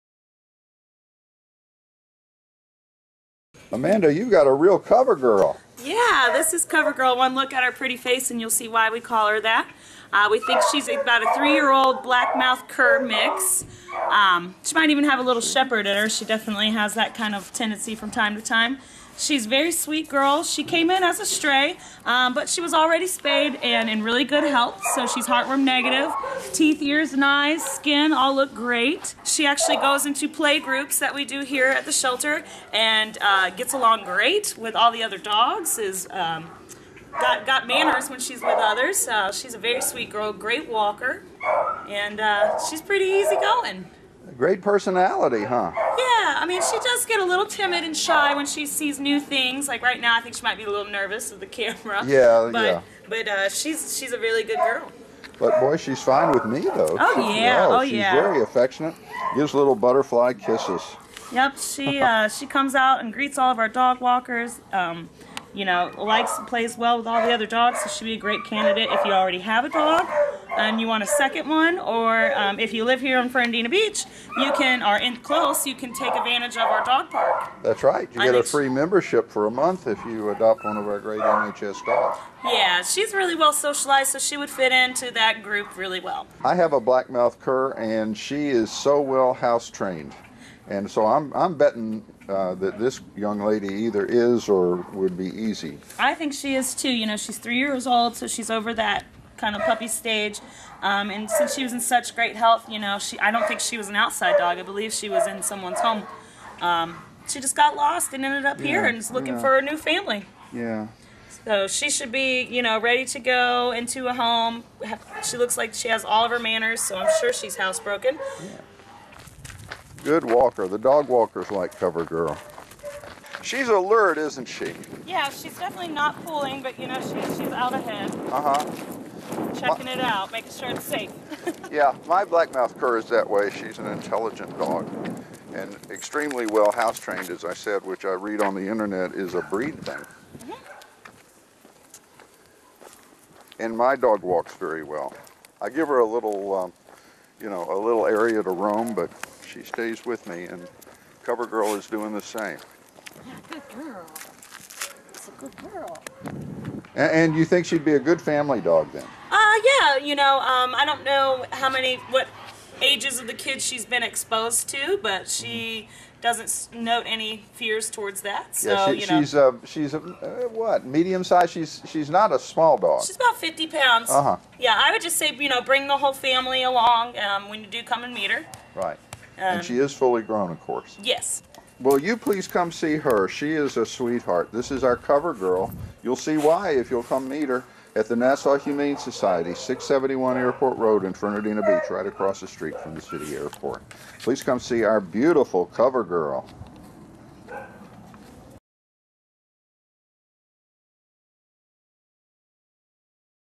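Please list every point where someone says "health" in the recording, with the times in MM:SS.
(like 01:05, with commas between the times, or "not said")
00:24, 01:42.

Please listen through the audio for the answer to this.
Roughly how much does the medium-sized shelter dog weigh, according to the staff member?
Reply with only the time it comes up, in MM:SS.
02:53.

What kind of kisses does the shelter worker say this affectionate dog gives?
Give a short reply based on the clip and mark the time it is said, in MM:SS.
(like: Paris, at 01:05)
Butterfly kisses, at 00:59.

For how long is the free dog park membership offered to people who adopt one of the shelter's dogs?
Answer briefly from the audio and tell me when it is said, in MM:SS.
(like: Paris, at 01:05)
A month, at 01:19.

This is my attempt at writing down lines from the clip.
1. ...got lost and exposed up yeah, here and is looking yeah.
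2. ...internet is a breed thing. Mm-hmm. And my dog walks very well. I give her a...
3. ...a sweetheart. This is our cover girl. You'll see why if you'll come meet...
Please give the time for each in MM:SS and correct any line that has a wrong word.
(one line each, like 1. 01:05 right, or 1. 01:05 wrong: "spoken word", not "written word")
1. 01:47 wrong: "ended", not "exposed"
2. 02:18 right
3. 03:03 right.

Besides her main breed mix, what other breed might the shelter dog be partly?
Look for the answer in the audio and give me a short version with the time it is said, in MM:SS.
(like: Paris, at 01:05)
Shepherd, at 00:15.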